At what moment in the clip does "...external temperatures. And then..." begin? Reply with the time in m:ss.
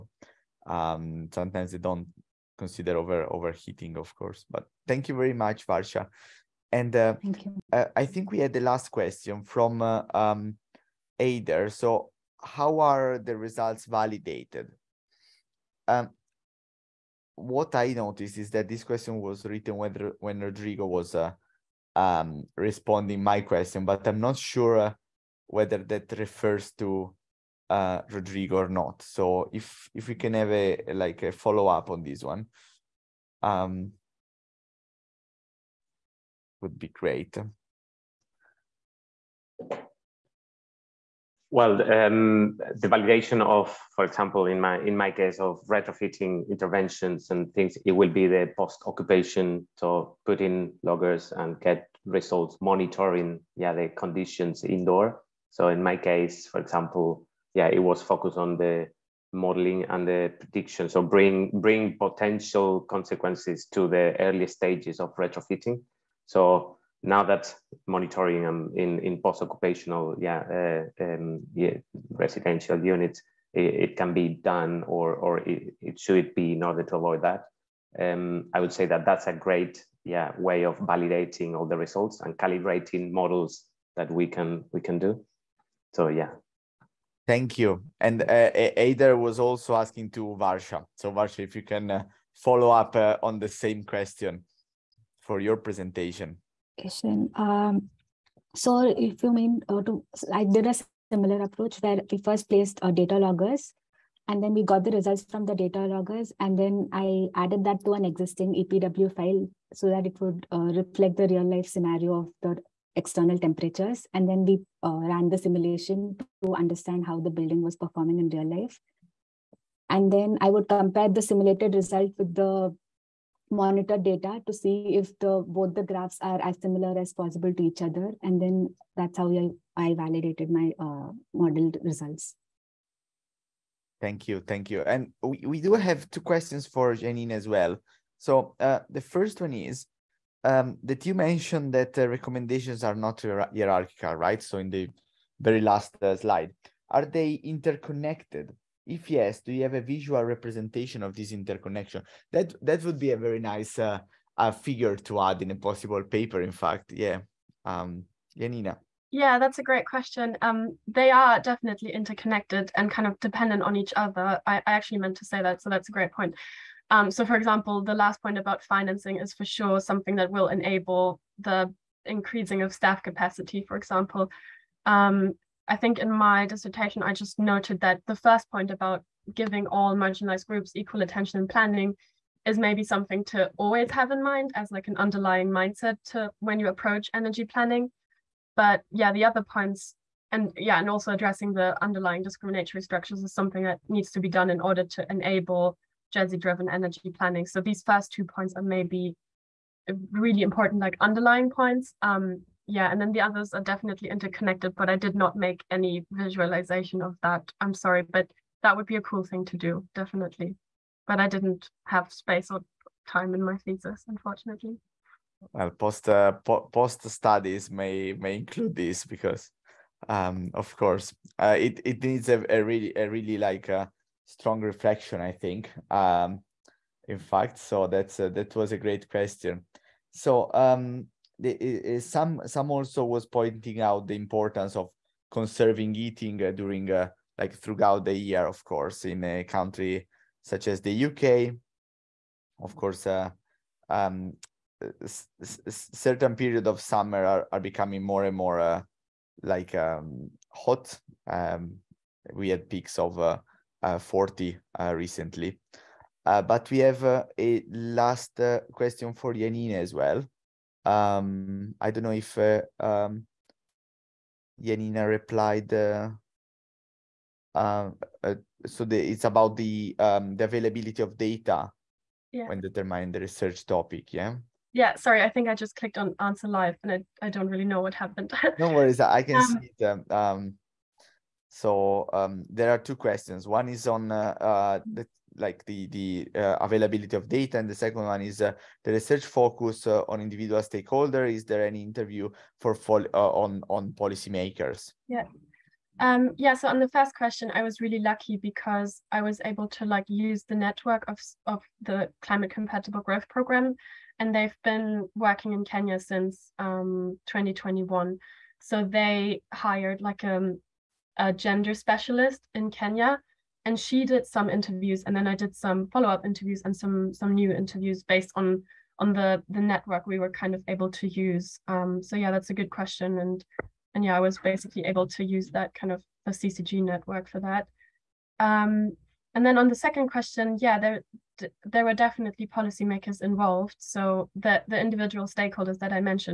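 1:52.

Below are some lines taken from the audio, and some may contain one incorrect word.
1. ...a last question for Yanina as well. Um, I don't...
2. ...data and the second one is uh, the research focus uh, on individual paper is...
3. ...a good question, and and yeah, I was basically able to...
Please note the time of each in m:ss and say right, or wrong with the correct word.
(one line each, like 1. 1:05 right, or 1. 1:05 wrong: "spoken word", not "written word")
1. 4:17 right
2. 4:47 wrong: "stakeholder", not "paper"
3. 5:22 right.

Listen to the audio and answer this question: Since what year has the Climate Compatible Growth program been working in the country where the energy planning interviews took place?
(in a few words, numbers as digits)
2021.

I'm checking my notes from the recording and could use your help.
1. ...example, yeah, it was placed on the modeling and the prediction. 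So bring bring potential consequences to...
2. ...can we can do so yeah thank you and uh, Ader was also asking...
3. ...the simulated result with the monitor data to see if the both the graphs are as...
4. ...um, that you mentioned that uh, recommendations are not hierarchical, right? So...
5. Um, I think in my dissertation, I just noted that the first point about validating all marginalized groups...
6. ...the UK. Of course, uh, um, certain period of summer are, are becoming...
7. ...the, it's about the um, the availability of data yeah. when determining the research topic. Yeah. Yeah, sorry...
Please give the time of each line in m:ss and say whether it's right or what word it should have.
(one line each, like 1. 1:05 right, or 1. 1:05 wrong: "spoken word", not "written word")
1. 0:56 wrong: "focused", not "placed"
2. 1:24 right
3. 2:01 right
4. 2:20 right
5. 2:54 wrong: "giving", not "validating"
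6. 4:00 right
7. 4:28 right.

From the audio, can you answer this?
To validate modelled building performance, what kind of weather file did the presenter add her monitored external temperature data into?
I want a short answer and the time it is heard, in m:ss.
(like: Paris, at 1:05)
EPW file, at 1:48.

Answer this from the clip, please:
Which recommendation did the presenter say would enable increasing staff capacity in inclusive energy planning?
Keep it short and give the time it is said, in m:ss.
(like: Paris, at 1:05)
Financing, at 2:48.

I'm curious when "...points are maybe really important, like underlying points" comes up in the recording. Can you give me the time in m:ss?
3:18.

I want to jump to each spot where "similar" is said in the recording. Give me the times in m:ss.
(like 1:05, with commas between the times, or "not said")
1:41, 2:06.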